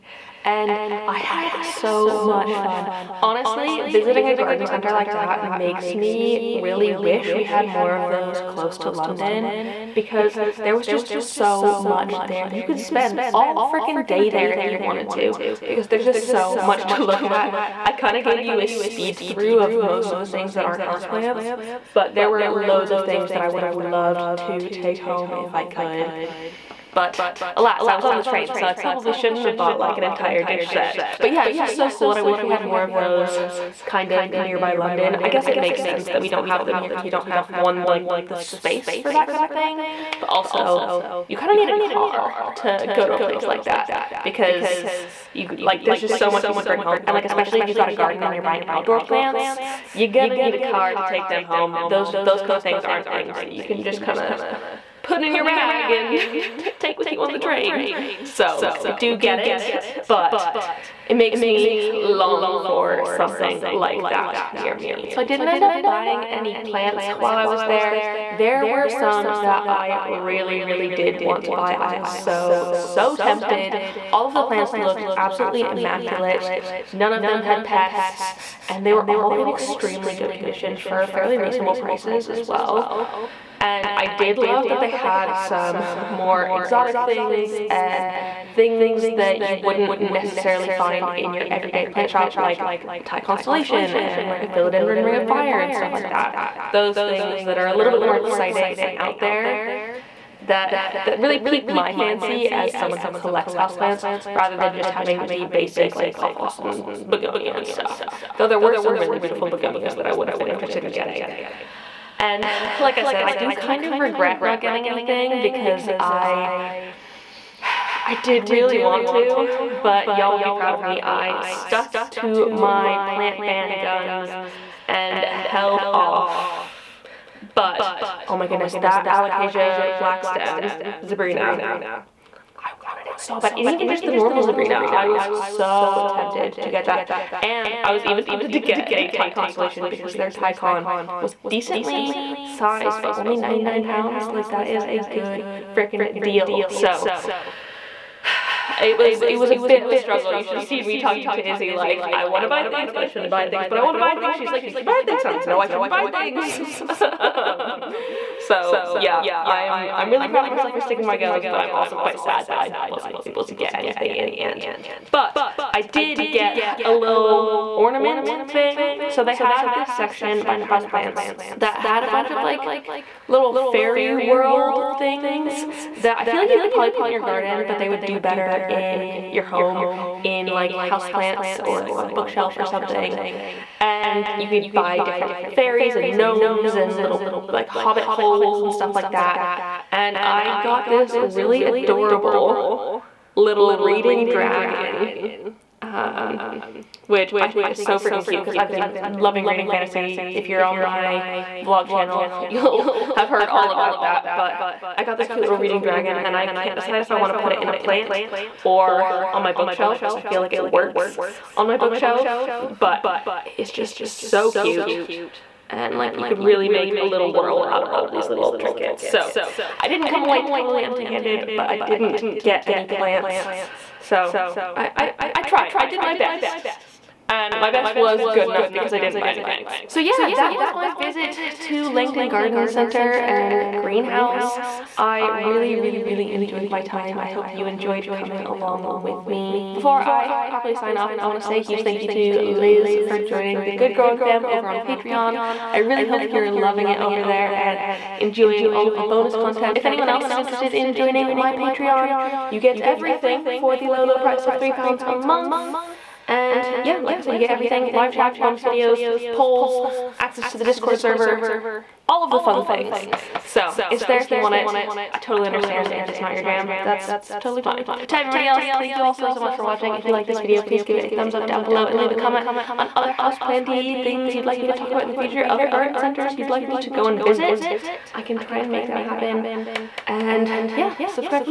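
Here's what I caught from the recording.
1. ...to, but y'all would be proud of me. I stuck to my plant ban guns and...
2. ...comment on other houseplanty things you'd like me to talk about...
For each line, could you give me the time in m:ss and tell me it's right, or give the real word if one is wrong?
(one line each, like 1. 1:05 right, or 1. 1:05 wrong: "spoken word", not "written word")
1. 1:59 right
2. 4:32 right.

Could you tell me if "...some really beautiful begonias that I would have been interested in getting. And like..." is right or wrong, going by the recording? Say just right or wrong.
right.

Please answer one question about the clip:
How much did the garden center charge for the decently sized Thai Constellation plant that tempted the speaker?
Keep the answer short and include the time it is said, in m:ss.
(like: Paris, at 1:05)
£99, at 2:23.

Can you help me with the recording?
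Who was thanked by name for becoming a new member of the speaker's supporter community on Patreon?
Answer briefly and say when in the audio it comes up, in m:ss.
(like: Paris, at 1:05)
Liz, at 4:02.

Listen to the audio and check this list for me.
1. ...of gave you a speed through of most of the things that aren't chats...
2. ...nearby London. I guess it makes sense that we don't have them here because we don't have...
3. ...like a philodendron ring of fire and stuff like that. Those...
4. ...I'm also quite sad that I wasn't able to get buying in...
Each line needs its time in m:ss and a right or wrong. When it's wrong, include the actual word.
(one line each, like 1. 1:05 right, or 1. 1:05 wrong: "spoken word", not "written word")
1. 0:18 wrong: "houseplants", not "chats"
2. 0:34 right
3. 1:34 right
4. 2:41 wrong: "anything", not "buying".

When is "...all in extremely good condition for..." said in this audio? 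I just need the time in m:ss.
1:19.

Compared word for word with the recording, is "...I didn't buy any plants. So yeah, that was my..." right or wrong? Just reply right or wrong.
right.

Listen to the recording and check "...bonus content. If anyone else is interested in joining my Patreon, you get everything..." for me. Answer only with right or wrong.
right.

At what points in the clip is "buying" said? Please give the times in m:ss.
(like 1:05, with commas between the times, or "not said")
0:48, 1:05.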